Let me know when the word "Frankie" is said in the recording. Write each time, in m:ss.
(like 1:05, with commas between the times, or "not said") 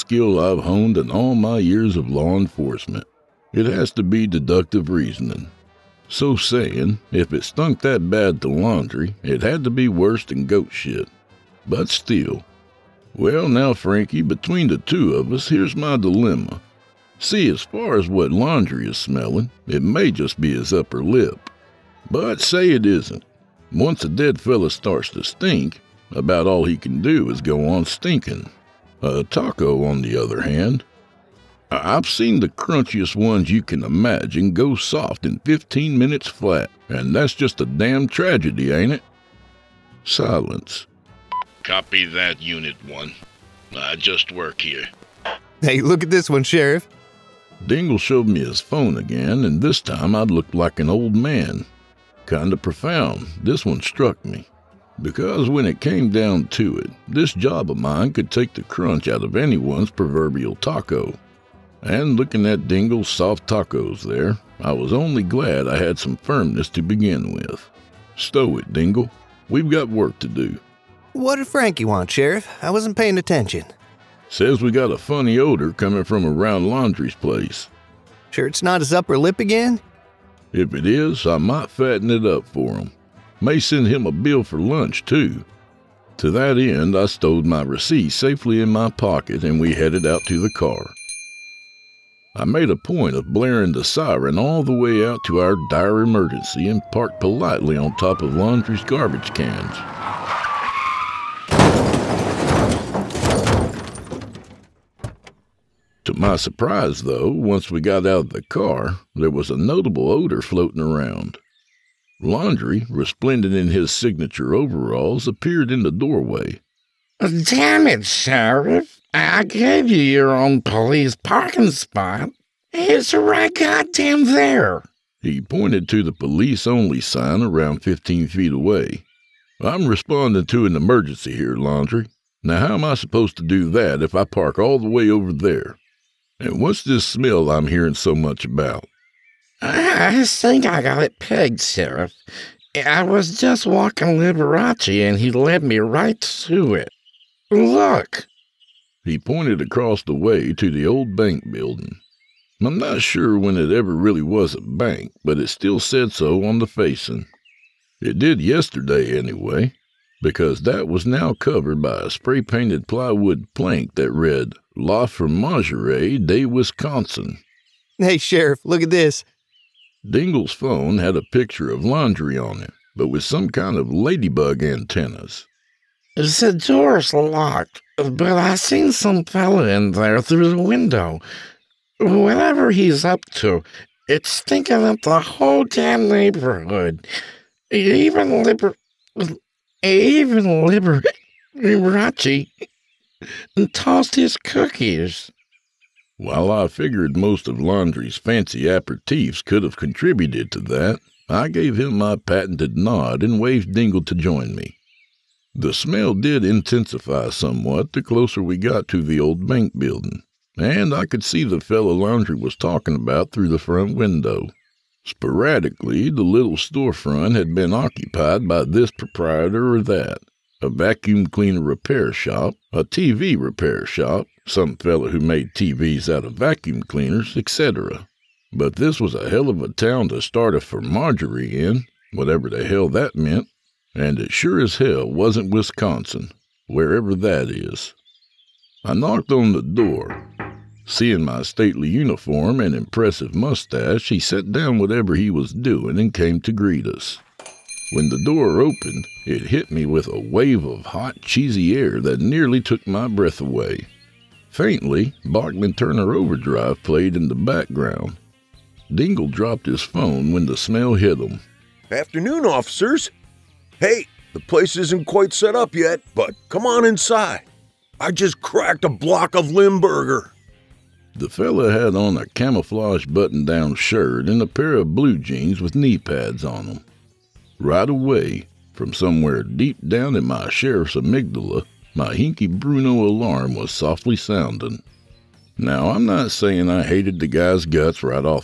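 0:13, 1:11.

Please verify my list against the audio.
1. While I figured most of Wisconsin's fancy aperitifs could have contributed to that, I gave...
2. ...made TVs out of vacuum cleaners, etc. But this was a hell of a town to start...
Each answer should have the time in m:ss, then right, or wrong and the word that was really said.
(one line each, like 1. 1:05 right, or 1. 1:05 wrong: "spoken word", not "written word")
1. 3:16 wrong: "Laundry", not "Wisconsin"
2. 3:45 right.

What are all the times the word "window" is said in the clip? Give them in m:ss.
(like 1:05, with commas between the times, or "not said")
3:00, 3:33.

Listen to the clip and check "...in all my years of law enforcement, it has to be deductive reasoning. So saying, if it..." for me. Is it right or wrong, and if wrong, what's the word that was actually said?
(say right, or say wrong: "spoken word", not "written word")
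right.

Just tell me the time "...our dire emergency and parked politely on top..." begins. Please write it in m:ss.
1:35.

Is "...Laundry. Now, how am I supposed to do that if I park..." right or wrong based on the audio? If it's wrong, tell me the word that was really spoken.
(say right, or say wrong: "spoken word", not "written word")
right.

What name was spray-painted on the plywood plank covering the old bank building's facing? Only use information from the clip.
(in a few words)
La Fromagerie de Wisconsin.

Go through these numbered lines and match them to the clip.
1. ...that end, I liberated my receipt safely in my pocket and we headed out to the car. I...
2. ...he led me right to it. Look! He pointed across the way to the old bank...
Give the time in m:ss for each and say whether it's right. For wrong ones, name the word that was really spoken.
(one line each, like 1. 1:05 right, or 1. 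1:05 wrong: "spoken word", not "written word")
1. 1:26 wrong: "stowed", not "liberated"
2. 2:25 right.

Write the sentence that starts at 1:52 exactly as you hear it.
Laundry, resplendent in his signature overalls, appeared in the doorway.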